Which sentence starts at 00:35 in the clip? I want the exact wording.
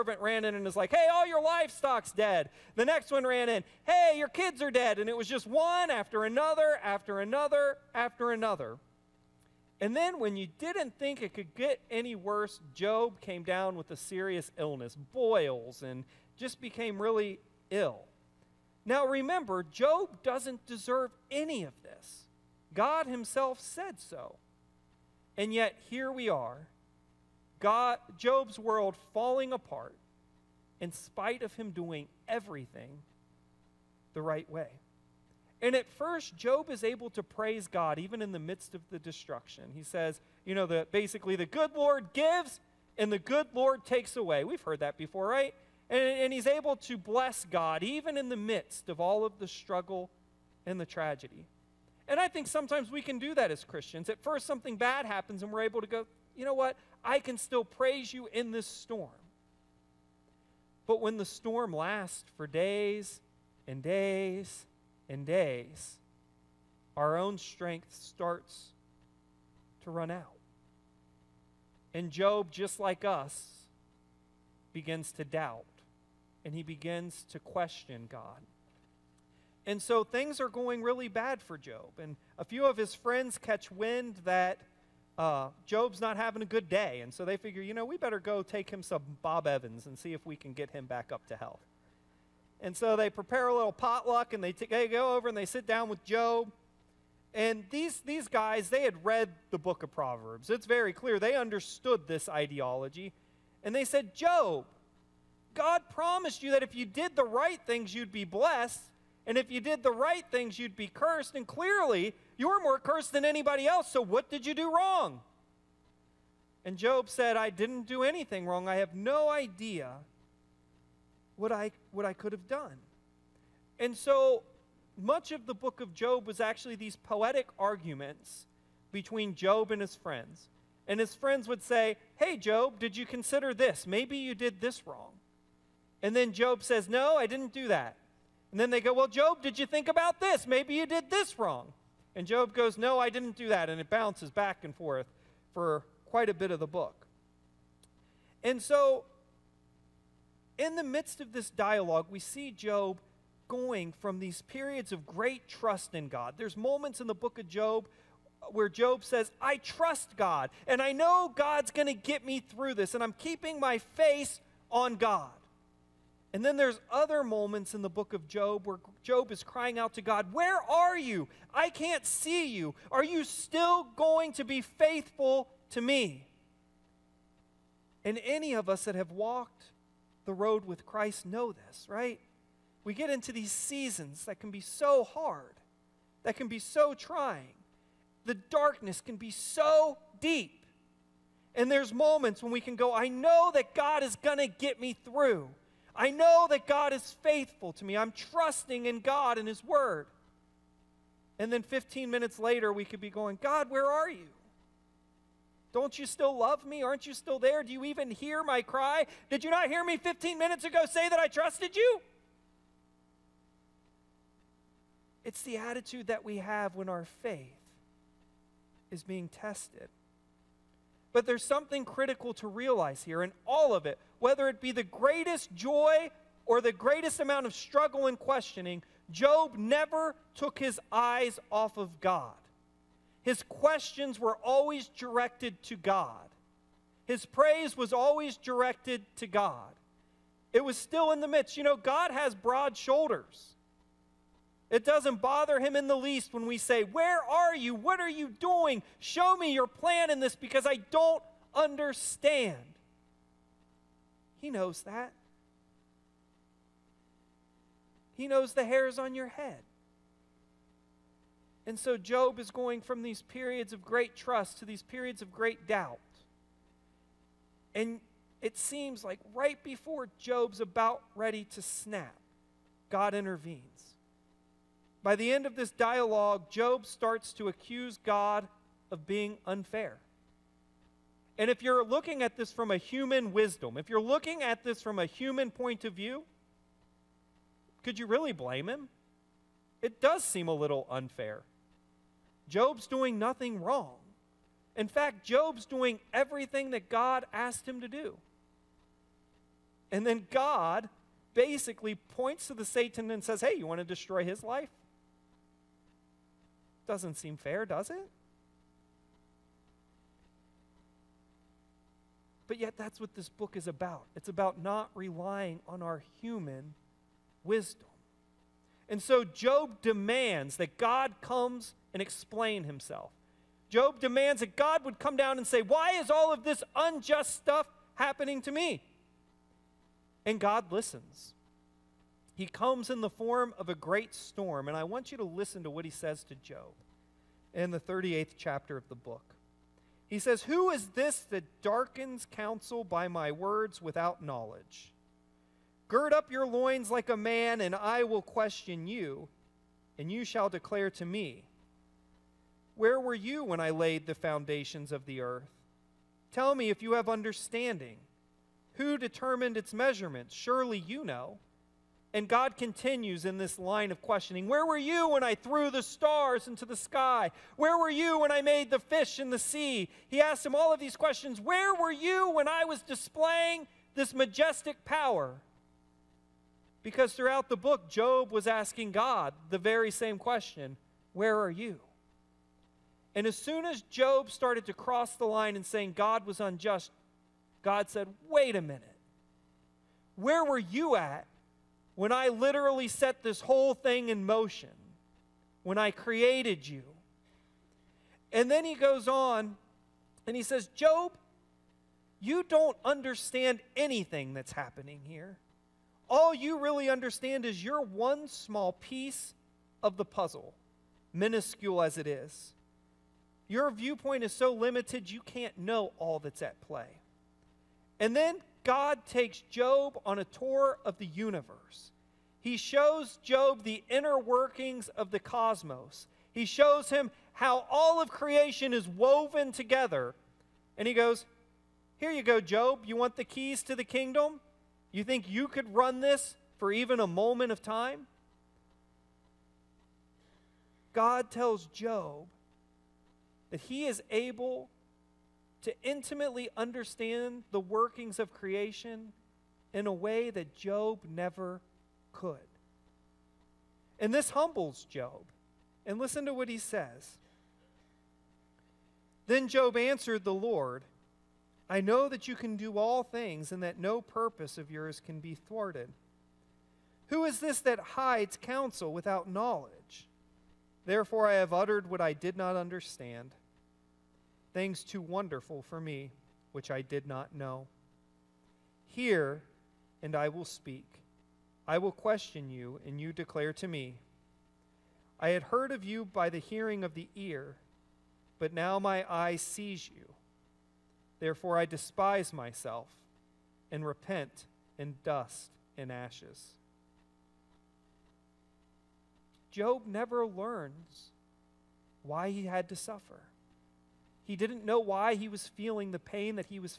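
And at first, Job is able to praise God even in the midst of the destruction.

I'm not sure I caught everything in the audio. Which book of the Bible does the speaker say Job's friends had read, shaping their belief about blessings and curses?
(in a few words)
Proverbs.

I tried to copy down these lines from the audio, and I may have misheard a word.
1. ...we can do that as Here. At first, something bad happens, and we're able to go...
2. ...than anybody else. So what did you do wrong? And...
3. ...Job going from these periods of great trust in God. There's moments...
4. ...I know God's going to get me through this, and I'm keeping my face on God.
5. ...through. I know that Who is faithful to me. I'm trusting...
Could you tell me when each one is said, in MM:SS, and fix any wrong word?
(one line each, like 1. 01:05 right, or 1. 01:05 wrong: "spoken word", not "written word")
1. 00:52 wrong: "Christians", not "Here"
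2. 01:53 right
3. 02:32 right
4. 02:40 right
5. 03:15 wrong: "God", not "Who".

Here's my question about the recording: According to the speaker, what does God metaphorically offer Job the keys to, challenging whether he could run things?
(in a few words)
the kingdom.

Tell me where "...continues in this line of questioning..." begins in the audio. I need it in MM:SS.
06:02.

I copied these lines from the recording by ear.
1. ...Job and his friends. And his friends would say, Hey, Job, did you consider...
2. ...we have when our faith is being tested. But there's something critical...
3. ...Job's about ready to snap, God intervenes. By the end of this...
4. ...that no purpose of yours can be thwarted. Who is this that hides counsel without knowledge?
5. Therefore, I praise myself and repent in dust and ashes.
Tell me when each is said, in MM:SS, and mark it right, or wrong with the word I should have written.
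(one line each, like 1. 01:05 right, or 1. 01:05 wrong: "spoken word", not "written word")
1. 02:09 right
2. 03:36 right
3. 04:30 right
4. 07:43 right
5. 08:11 wrong: "despise", not "praise".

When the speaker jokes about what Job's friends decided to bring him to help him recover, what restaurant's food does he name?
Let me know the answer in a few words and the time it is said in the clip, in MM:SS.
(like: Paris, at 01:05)
Bob Evans, at 01:29.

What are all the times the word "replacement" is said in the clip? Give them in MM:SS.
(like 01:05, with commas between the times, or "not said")
not said.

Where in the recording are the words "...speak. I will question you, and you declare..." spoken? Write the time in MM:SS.
08:00.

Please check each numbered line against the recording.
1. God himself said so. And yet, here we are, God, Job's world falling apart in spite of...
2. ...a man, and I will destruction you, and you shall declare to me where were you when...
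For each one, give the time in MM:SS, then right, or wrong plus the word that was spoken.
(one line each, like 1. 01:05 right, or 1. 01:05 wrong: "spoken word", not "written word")
1. 00:22 right
2. 05:47 wrong: "question", not "destruction".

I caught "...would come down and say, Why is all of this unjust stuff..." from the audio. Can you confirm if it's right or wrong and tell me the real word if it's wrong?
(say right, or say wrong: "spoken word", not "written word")
right.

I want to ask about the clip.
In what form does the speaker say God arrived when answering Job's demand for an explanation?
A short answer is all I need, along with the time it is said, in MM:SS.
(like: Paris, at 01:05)
a great storm, at 05:33.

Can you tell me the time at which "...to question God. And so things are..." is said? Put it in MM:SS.
01:17.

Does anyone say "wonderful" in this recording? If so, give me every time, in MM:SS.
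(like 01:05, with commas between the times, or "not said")
07:55.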